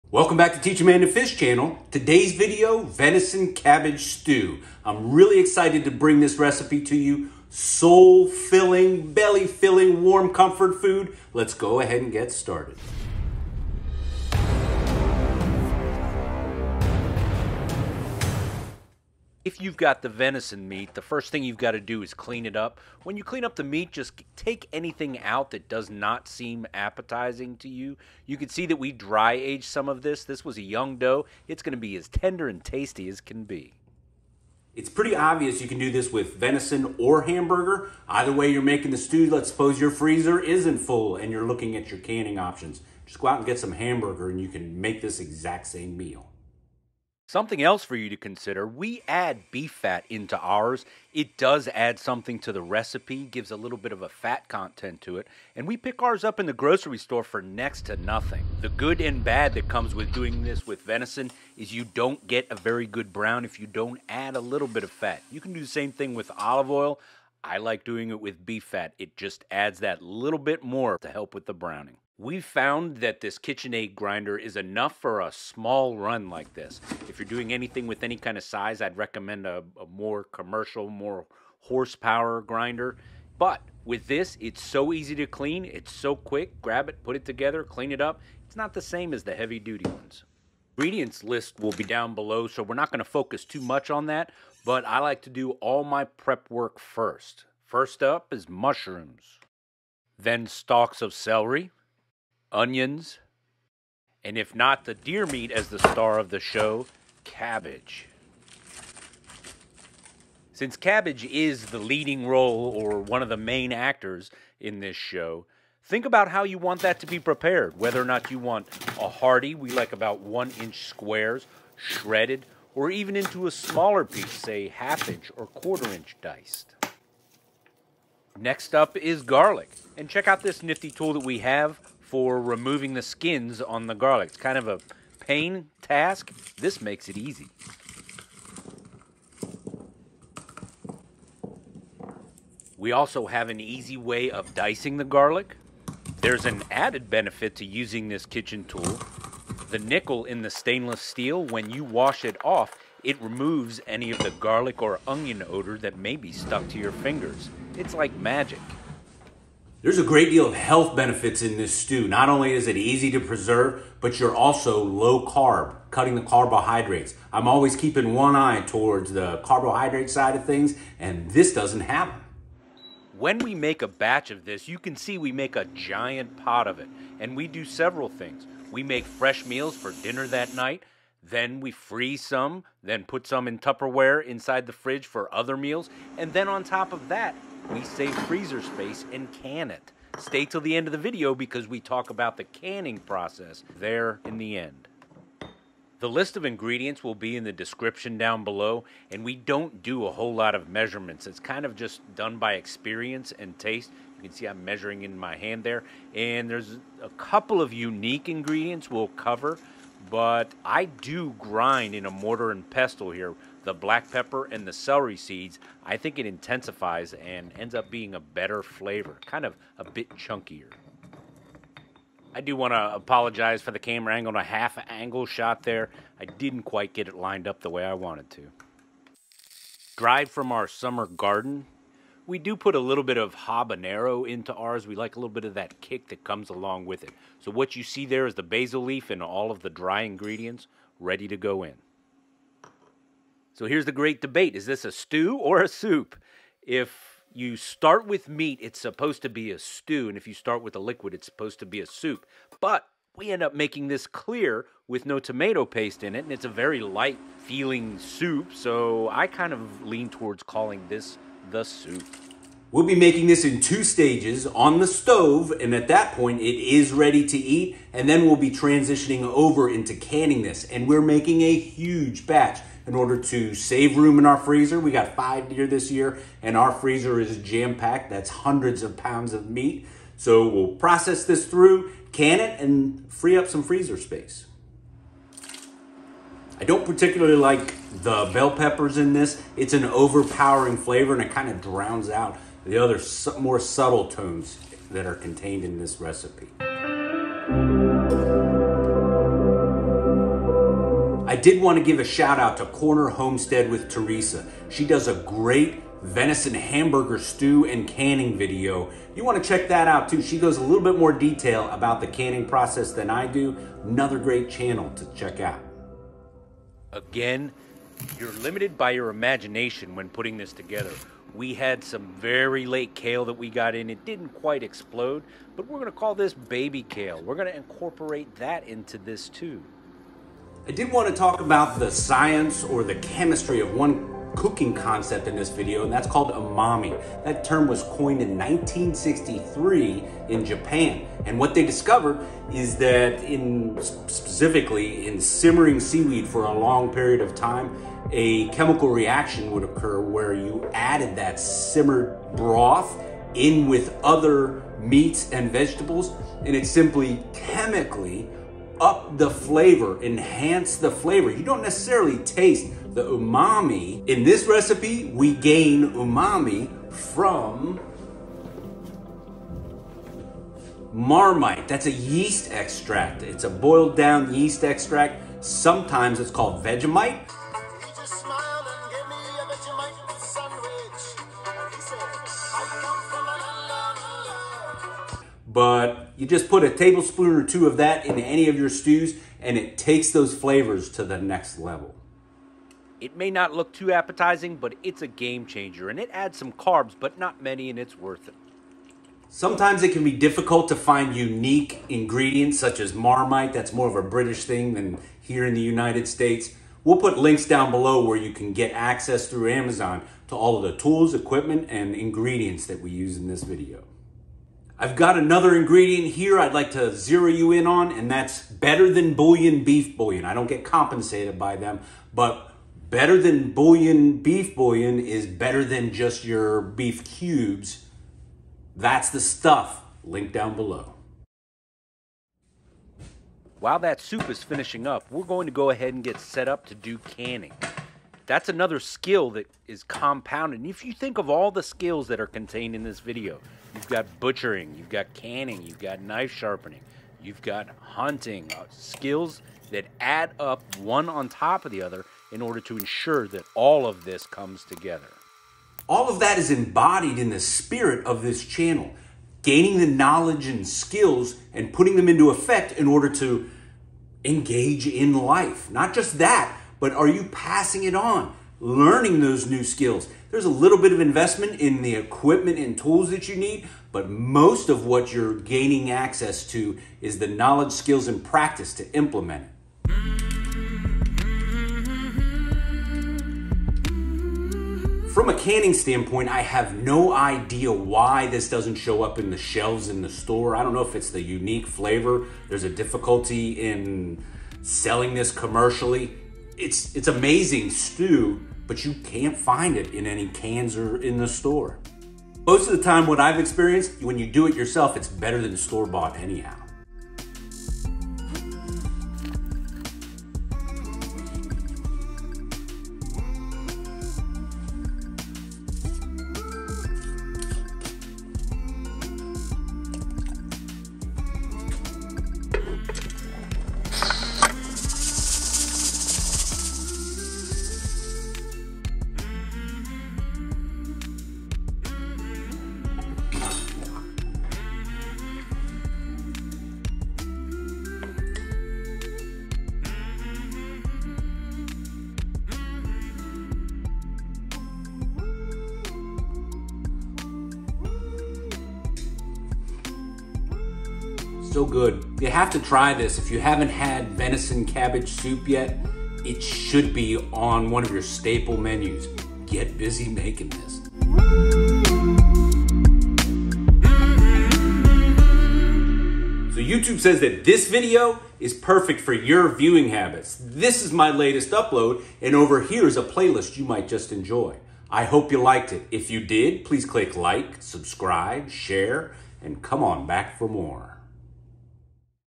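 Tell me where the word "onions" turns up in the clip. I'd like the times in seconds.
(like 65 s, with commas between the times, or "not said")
102 s, 155 s.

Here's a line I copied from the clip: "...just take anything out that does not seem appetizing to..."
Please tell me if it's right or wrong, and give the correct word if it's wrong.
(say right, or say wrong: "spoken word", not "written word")
right.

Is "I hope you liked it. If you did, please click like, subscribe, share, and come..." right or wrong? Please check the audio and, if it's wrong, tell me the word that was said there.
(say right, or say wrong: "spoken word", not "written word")
right.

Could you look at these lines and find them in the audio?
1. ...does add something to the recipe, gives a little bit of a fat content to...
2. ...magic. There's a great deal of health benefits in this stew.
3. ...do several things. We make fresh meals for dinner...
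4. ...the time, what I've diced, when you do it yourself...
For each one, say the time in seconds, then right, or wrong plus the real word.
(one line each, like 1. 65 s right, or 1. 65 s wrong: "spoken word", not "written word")
1. 51 s right
2. 158 s right
3. 177 s right
4. 502 s wrong: "experienced", not "diced".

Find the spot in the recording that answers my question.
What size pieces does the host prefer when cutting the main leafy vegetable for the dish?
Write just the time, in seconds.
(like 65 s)
120 s.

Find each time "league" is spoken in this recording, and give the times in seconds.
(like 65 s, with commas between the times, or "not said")
not said.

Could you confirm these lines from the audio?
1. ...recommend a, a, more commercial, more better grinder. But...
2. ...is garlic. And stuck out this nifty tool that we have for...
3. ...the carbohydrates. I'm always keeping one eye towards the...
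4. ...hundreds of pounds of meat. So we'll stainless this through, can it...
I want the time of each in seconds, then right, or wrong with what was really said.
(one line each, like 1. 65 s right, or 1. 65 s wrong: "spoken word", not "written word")
1. 78 s wrong: "horsepower", not "better"
2. 128 s wrong: "check", not "stuck"
3. 166 s right
4. 278 s wrong: "process", not "stainless".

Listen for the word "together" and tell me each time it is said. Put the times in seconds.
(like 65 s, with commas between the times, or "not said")
87 s, 320 s, 454 s.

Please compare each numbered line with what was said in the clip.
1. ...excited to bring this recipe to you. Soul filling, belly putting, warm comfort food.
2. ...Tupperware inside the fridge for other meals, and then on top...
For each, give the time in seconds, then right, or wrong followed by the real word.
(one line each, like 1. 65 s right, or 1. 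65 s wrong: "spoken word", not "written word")
1. 5 s wrong: "filling", not "putting"
2. 183 s right.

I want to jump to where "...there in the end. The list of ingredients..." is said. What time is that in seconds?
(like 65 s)
193 s.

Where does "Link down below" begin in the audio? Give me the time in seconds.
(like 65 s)
430 s.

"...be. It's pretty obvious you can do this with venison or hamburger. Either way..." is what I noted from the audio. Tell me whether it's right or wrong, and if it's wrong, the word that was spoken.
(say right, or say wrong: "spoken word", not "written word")
right.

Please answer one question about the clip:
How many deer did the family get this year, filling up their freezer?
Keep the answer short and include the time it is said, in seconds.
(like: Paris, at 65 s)
5, at 275 s.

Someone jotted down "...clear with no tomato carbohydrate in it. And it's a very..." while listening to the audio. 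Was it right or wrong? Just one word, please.
wrong.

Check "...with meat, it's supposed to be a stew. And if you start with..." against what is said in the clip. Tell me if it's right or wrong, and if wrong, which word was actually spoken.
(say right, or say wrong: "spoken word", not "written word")
right.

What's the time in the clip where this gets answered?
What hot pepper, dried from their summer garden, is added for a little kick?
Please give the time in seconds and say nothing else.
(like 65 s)
233 s.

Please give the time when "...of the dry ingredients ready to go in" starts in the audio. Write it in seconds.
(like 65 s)
239 s.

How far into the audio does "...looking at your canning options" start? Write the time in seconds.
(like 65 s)
41 s.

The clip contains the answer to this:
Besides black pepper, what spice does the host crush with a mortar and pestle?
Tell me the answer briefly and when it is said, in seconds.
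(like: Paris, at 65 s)
Celery seeds, at 214 s.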